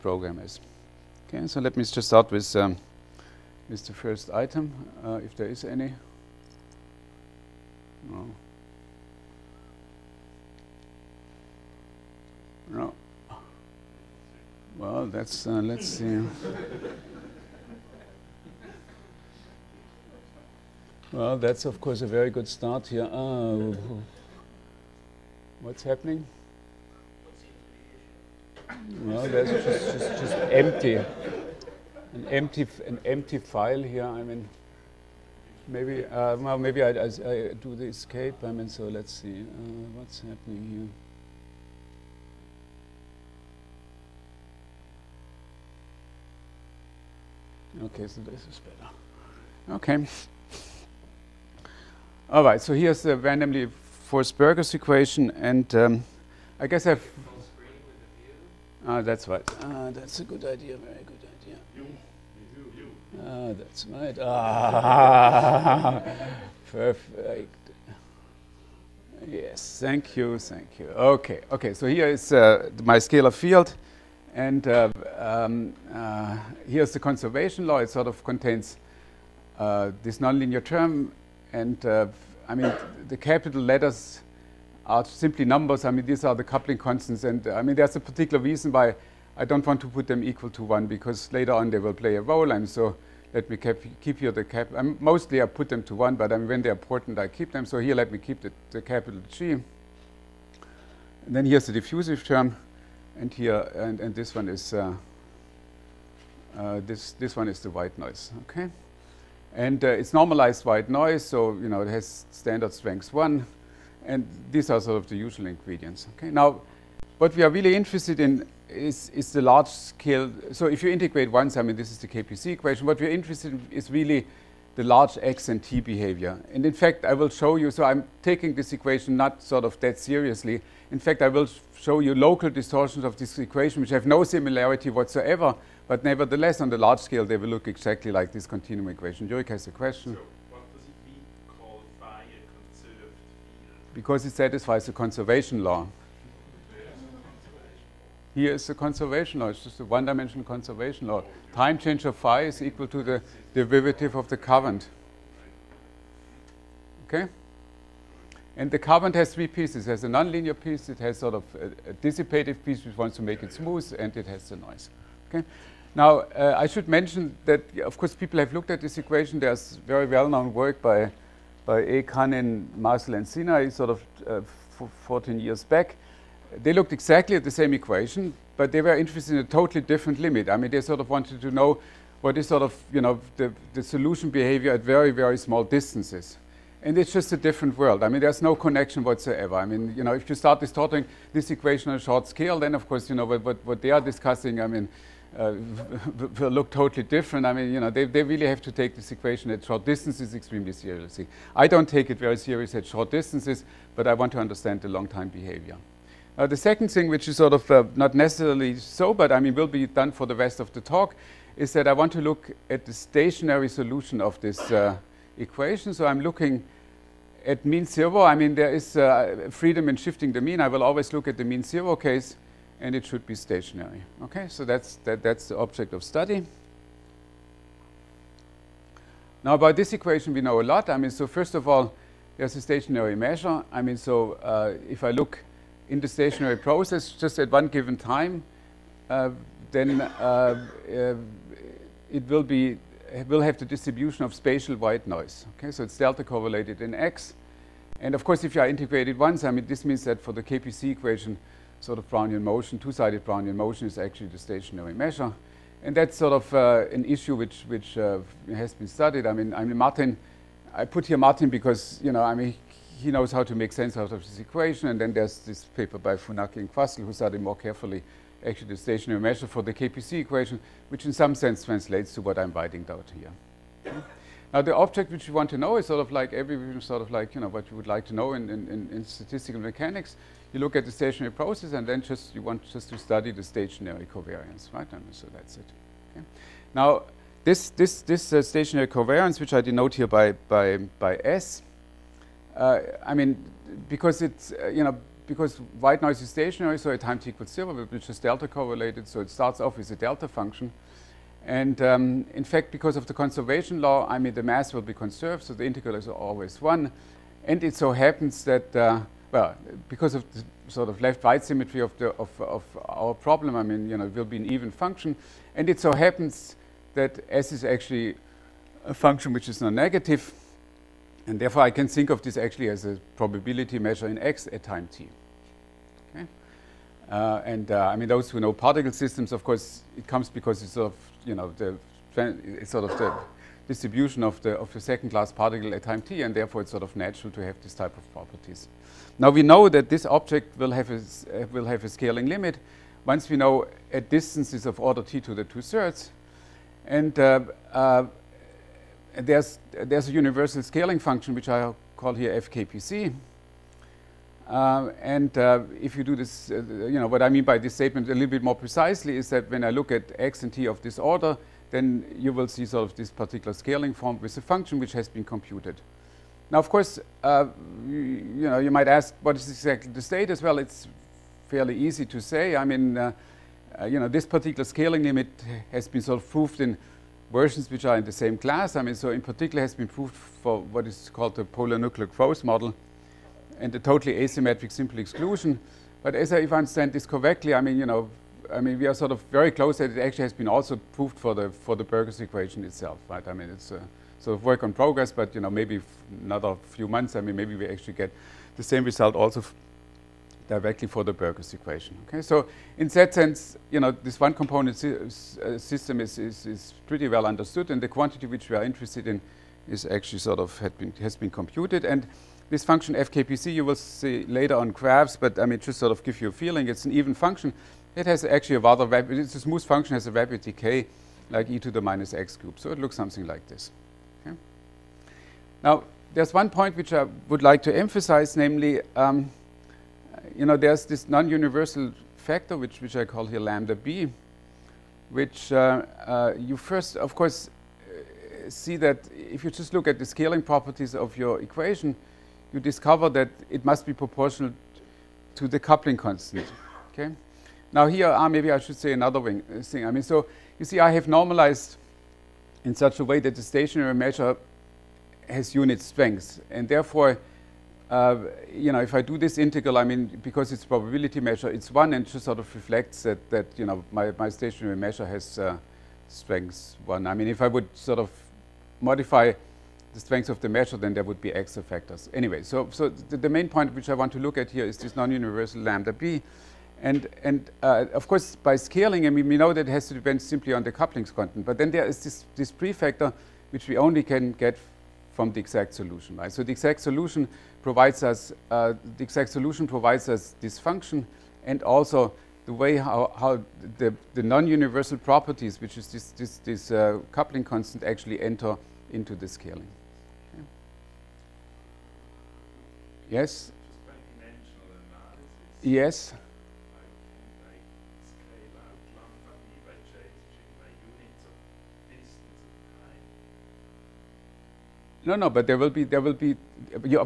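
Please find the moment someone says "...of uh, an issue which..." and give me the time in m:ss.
4:16.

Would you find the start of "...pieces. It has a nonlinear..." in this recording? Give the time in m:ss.
2:39.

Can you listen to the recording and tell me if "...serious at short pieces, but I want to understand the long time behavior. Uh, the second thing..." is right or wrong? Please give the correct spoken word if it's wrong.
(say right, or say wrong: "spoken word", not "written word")
wrong: "distances", not "pieces".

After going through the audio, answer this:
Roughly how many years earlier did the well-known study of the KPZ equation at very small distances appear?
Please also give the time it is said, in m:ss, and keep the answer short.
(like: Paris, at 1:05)
14, at 2:55.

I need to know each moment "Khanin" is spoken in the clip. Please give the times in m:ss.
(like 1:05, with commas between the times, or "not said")
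2:52.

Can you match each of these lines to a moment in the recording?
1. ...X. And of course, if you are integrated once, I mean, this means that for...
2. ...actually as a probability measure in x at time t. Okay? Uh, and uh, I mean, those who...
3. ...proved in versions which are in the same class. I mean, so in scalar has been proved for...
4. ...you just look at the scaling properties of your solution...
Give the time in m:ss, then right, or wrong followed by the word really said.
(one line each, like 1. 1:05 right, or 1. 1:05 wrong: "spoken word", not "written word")
1. 4:06 right
2. 5:22 right
3. 6:16 wrong: "particular", not "scalar"
4. 7:19 wrong: "equation", not "solution".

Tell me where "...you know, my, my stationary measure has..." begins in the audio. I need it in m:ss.
7:43.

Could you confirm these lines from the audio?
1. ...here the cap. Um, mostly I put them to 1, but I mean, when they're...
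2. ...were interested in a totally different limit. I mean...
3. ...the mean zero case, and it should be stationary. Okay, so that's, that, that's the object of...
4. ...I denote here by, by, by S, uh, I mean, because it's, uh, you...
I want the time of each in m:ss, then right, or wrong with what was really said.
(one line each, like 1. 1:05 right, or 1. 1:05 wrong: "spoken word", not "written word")
1. 1:34 right
2. 2:58 right
3. 3:41 right
4. 4:49 right.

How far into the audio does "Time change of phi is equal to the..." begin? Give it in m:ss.
2:31.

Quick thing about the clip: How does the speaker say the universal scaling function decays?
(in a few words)
e to the minus x cubed.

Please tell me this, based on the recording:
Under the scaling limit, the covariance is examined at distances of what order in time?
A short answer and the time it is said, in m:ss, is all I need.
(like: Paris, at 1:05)
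t to the two-thirds, at 5:45.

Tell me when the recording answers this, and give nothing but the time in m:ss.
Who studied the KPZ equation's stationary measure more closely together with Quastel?
4:26.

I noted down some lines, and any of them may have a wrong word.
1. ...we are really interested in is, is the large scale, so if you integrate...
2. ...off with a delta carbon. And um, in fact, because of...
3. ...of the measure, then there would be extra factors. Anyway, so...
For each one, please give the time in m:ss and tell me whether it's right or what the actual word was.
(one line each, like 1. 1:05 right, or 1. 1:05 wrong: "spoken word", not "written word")
1. 1:57 right
2. 4:59 wrong: "function", not "carbon"
3. 7:50 right.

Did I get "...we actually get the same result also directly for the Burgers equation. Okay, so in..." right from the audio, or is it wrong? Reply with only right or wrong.
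right.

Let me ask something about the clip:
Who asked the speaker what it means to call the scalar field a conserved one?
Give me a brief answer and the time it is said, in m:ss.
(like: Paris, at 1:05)
Jurek, at 2:19.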